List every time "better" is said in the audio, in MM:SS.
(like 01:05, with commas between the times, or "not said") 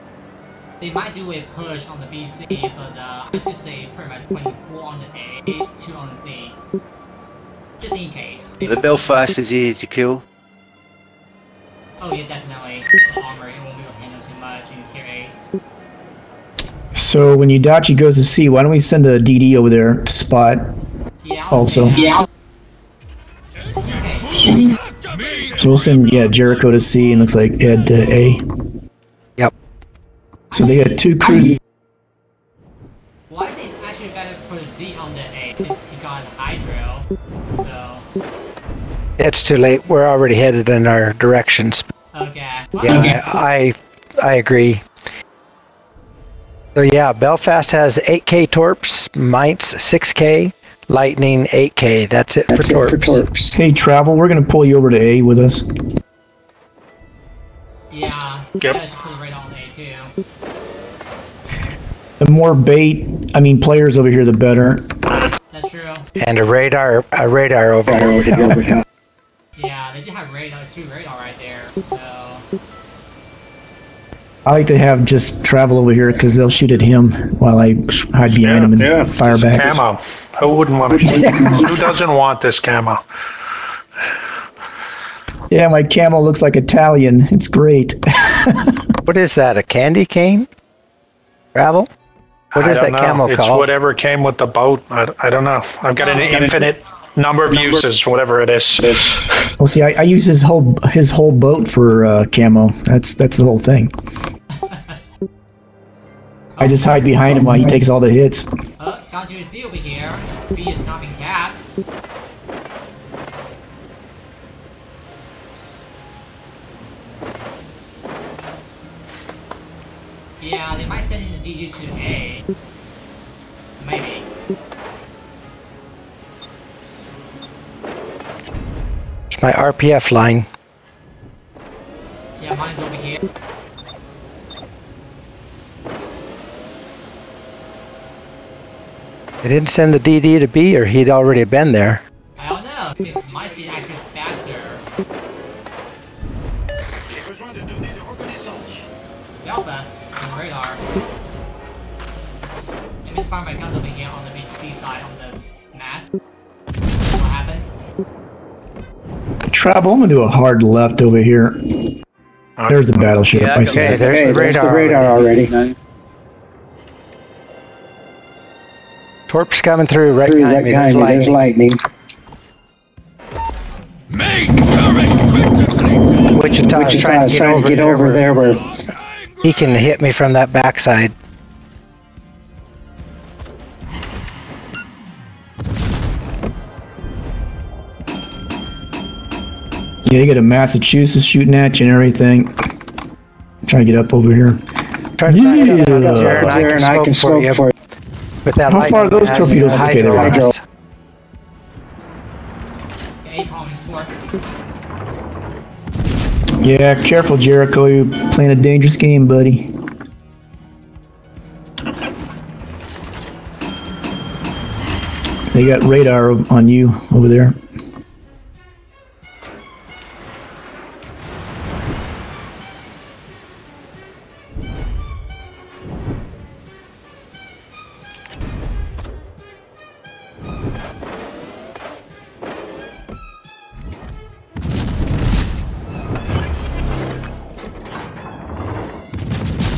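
00:34, 01:04.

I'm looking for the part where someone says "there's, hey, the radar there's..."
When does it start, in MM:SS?
02:43.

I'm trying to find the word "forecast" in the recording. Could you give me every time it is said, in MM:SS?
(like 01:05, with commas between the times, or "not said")
not said.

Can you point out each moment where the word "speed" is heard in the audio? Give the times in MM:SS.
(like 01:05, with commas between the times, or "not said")
02:23.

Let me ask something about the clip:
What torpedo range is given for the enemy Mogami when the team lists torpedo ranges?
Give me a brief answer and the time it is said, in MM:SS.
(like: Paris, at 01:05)
6K, at 00:49.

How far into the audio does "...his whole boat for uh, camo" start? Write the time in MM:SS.
01:40.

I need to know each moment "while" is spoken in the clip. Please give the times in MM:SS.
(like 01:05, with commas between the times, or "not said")
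01:17, 01:47.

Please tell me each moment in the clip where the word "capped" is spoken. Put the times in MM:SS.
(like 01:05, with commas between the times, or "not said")
01:51.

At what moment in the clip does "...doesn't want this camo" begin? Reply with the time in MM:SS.
01:21.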